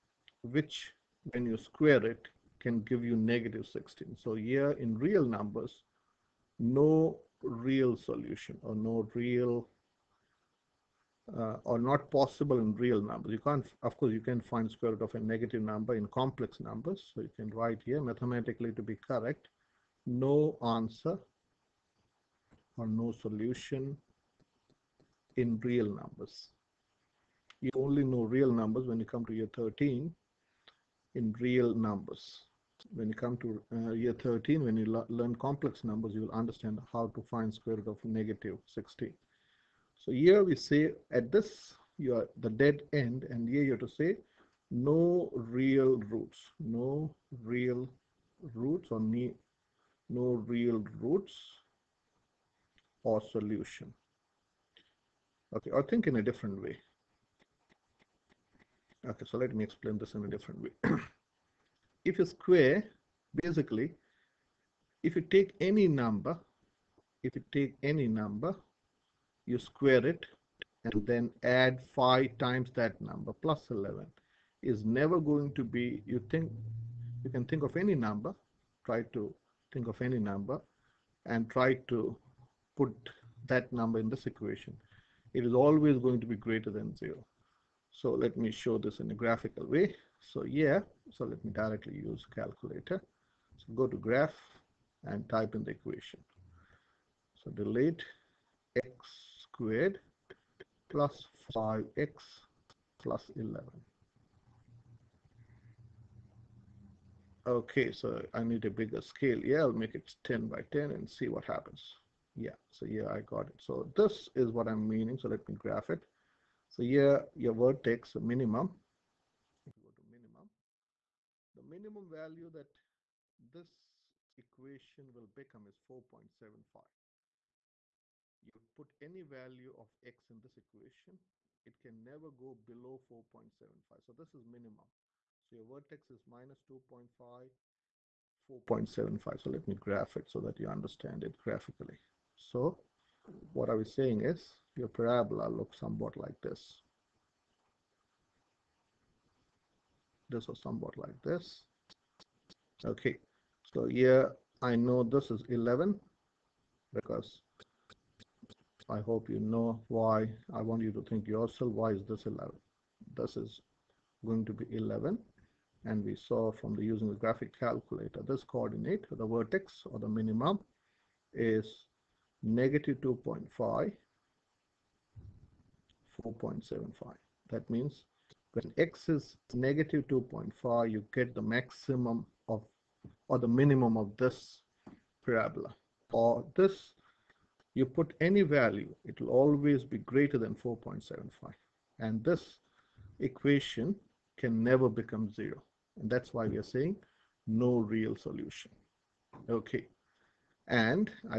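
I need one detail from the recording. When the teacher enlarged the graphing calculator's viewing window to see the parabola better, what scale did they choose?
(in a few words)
10 by 10.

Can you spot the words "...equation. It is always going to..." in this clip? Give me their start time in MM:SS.
01:24.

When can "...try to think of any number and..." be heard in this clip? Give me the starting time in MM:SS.
01:18.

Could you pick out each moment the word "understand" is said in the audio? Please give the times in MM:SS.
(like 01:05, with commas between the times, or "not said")
00:36, 02:20.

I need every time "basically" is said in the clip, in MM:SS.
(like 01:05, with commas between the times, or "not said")
01:03.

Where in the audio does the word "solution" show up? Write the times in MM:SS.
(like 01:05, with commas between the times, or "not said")
00:07, 00:23, 00:53, 03:18.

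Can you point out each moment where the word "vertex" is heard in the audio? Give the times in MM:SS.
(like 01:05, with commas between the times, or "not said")
01:57, 02:15, 02:49.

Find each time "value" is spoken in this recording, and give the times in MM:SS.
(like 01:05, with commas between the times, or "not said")
02:02, 02:09, 03:08.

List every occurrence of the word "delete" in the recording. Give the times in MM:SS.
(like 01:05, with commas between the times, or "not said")
01:37.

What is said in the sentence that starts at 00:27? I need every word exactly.
You only know real numbers when you come to year 13 in real numbers.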